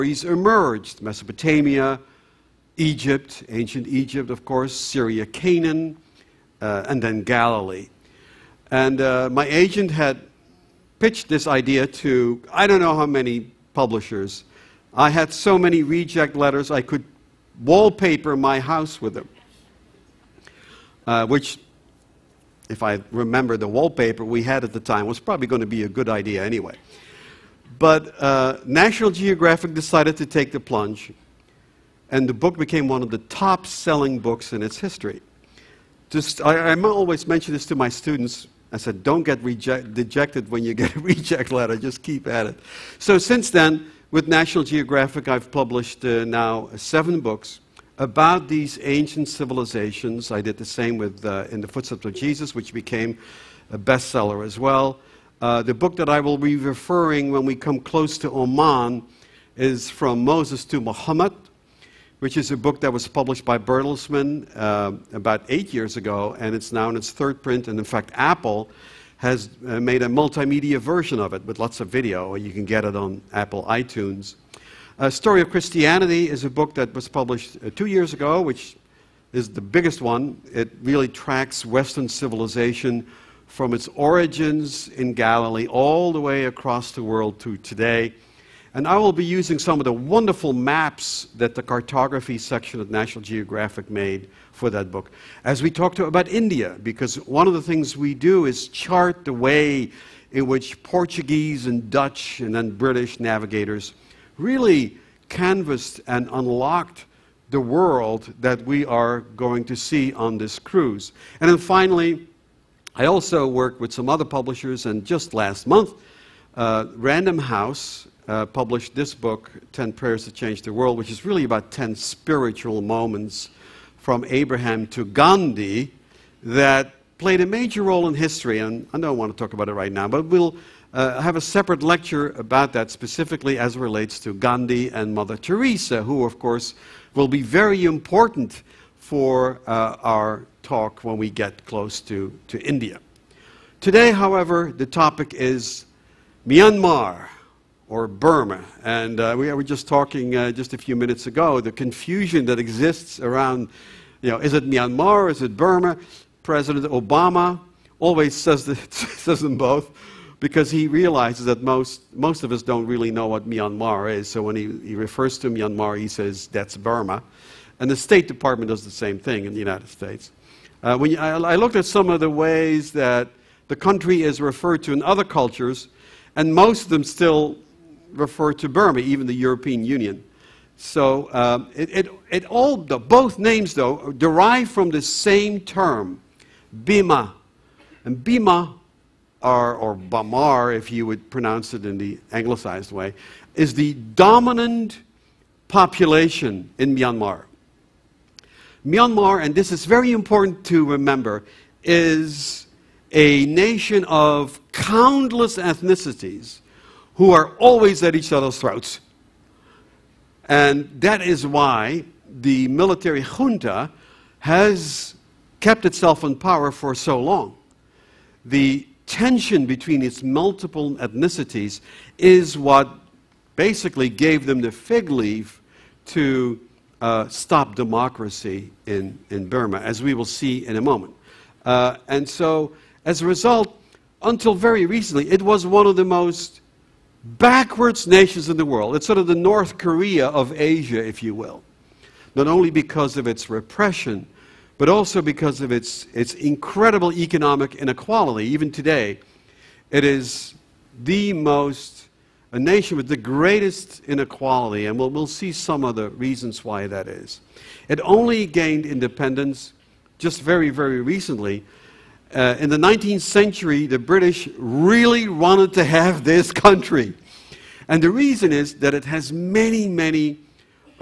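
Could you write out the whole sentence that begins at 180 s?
So um, it, it, it, all, the, both names though, derive from the same term, Bima.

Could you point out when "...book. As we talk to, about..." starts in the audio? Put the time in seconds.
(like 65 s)
94 s.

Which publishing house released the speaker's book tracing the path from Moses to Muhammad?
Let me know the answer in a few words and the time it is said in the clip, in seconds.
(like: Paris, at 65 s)
Bertelsmann, at 63 s.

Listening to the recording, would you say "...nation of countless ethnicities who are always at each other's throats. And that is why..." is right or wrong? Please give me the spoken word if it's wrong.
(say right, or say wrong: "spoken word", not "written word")
right.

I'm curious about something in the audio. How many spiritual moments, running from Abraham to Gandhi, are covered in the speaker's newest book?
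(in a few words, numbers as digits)
10.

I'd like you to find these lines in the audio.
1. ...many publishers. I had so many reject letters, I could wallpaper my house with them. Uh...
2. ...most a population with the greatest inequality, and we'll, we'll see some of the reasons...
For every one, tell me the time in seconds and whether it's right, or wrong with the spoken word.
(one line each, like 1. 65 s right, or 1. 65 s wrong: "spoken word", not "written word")
1. 13 s right
2. 251 s wrong: "nation", not "population".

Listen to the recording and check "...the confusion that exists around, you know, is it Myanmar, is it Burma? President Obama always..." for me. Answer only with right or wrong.
right.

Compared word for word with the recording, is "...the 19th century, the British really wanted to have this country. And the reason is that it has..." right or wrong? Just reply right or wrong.
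right.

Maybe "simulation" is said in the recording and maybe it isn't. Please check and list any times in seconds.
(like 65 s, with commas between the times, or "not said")
not said.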